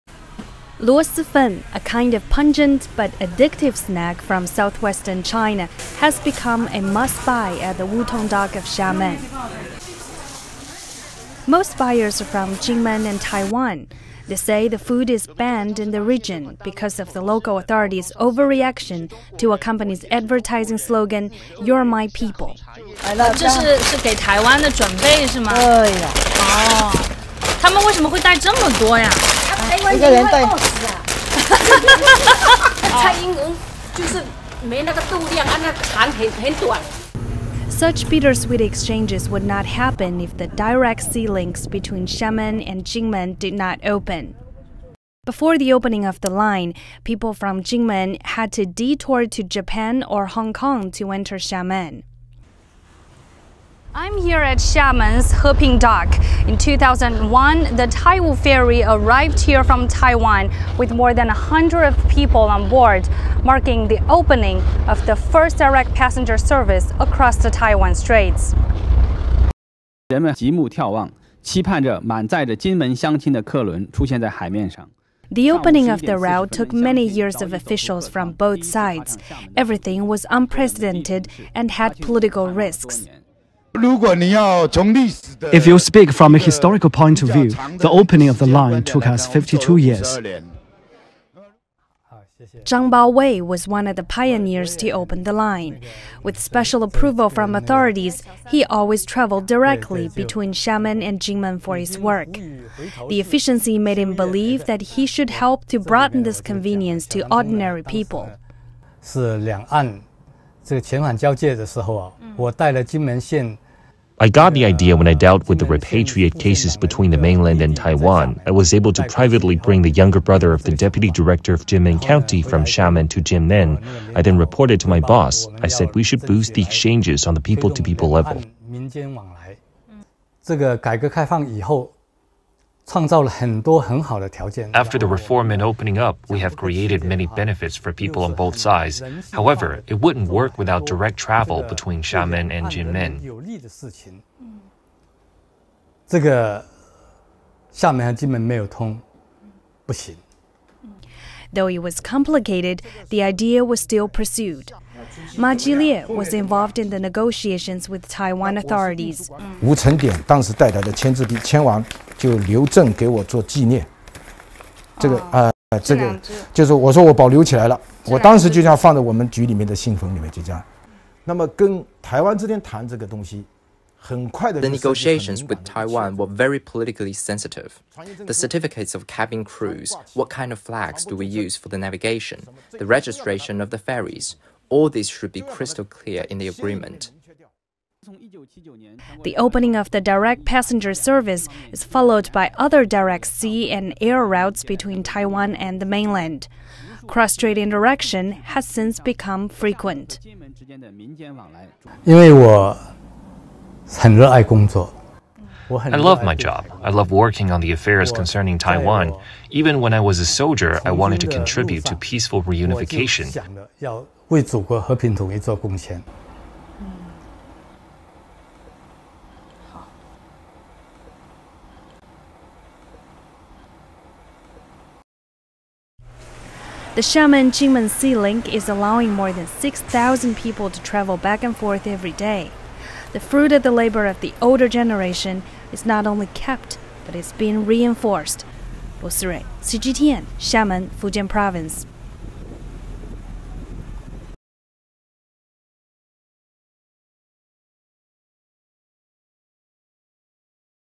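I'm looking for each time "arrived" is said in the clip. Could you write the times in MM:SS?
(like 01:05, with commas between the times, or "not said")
00:58.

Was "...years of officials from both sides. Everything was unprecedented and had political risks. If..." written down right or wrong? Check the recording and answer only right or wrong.
right.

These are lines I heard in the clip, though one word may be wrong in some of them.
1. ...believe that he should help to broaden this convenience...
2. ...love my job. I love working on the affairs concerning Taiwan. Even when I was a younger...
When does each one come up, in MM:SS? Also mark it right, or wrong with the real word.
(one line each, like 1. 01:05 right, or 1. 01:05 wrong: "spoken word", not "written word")
1. 01:44 right
2. 03:25 wrong: "soldier", not "younger".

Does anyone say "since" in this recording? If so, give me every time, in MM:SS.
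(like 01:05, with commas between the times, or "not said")
03:18.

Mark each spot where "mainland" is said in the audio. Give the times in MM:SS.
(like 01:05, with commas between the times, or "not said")
01:57, 03:15.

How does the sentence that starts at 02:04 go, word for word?
I then reported to my boss.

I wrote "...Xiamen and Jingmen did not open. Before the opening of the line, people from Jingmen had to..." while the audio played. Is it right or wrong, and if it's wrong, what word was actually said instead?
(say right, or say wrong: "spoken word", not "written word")
right.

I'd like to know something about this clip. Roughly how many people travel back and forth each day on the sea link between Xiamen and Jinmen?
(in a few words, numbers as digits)
6,000.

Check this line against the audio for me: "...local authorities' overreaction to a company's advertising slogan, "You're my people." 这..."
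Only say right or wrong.
right.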